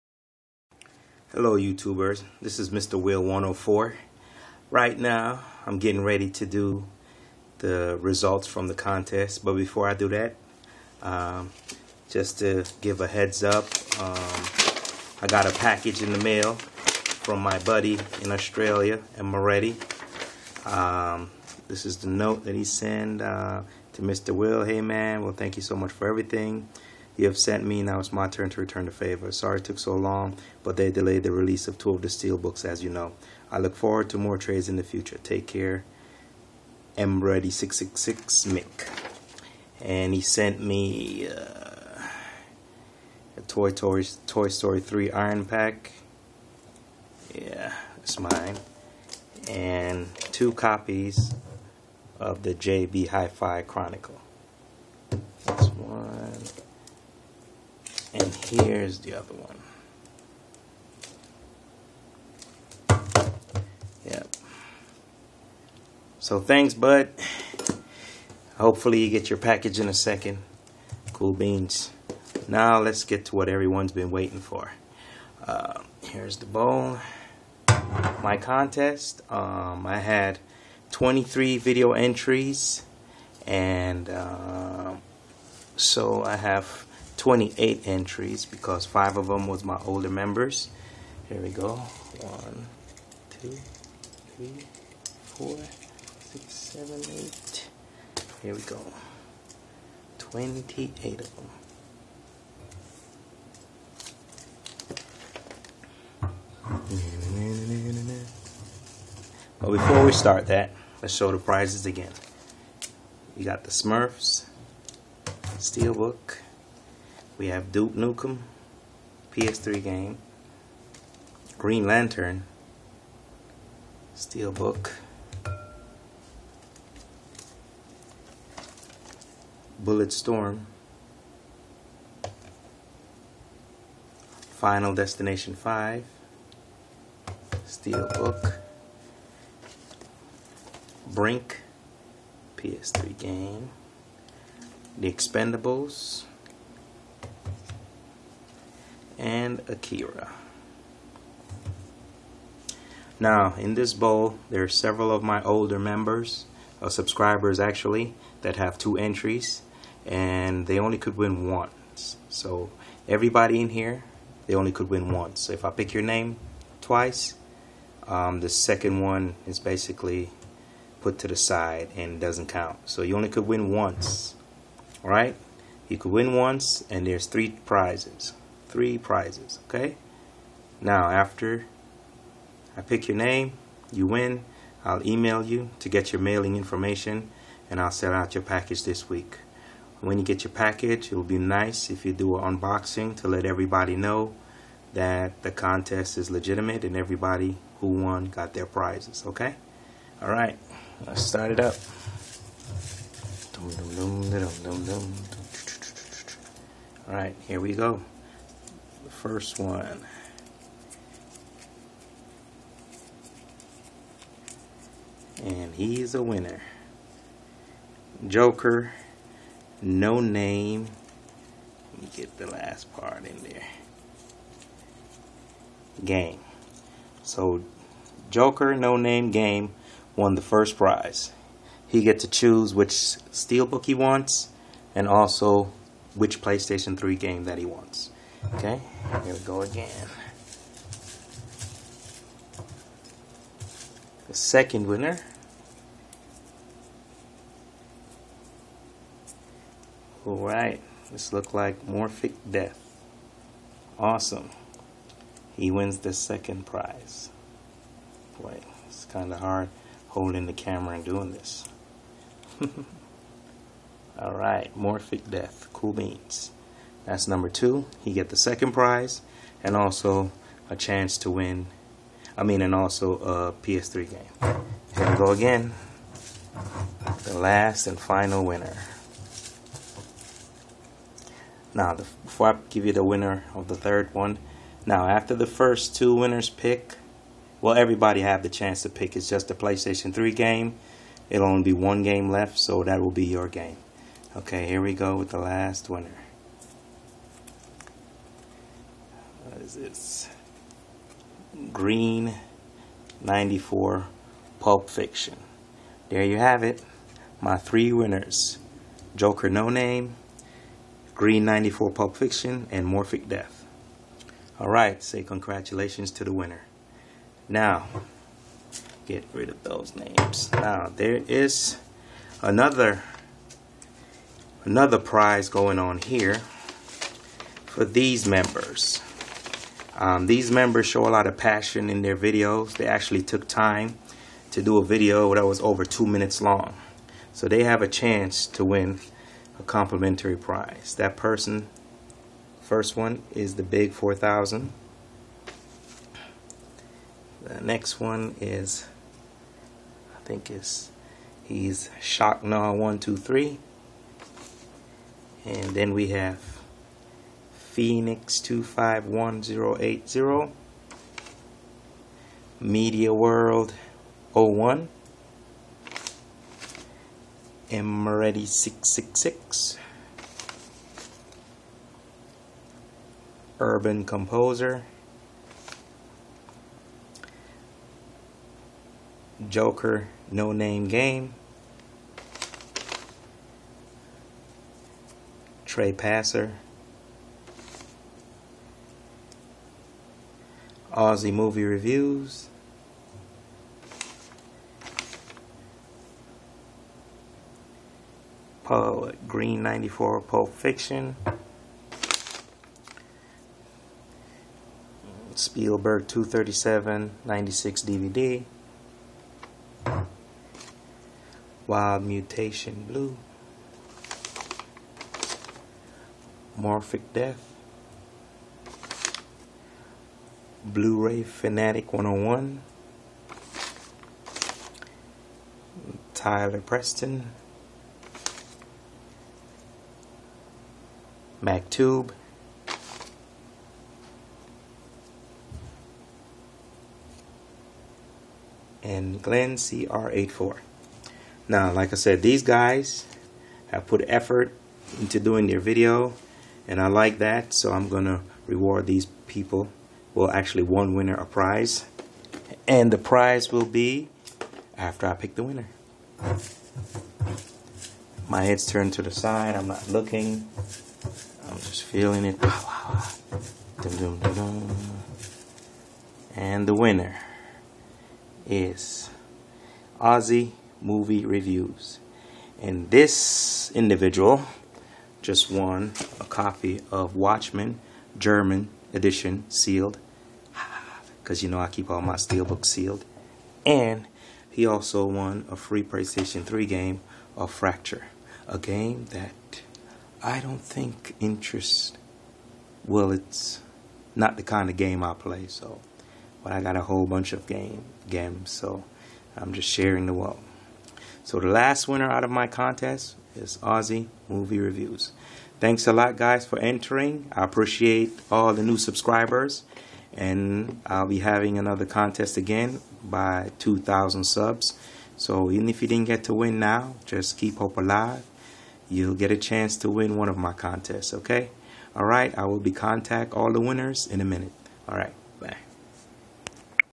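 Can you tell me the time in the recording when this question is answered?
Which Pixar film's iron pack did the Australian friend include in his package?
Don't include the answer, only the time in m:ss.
0:44.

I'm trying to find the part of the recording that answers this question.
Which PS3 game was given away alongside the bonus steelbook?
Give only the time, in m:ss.
8:07.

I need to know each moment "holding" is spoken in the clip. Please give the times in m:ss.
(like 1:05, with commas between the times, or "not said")
4:20.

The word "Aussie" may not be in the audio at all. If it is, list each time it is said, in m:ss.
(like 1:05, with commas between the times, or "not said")
6:30, 7:49, 8:23.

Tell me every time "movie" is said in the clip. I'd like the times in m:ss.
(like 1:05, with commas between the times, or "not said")
6:31, 7:50, 8:24.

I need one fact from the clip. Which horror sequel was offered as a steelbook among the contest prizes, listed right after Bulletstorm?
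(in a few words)
Final Destination 5.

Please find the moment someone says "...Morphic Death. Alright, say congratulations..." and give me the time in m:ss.
5:12.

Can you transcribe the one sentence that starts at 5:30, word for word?
Um, these members show a lot of passion in their videos.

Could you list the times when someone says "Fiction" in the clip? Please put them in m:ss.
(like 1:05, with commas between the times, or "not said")
5:04, 5:12, 6:40.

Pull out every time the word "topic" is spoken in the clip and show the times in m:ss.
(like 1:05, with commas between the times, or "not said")
not said.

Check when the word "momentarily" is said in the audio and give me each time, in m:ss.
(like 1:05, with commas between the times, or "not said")
not said.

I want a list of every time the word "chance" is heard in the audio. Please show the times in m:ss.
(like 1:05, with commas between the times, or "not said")
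4:30, 4:48, 5:37, 8:39.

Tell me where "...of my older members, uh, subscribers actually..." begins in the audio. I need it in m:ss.
2:35.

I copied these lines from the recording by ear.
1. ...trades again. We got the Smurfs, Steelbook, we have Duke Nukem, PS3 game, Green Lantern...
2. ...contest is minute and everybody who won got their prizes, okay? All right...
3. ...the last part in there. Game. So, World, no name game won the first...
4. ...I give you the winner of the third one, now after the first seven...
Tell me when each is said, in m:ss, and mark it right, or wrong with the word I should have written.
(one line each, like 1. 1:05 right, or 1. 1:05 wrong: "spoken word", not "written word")
1. 1:51 wrong: "prizes", not "trades"
2. 3:15 wrong: "legitimate", not "minute"
3. 3:42 wrong: "Joker", not "World"
4. 4:42 wrong: "two", not "seven".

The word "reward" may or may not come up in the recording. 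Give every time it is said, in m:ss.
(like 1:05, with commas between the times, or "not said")
7:28.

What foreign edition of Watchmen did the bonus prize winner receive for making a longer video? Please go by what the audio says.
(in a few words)
German edition.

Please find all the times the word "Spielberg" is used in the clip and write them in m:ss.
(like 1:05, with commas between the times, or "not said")
6:45.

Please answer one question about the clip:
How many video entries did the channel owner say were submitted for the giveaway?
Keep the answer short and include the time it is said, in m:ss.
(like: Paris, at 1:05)
23, at 1:20.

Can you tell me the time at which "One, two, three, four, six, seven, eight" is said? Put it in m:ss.
1:32.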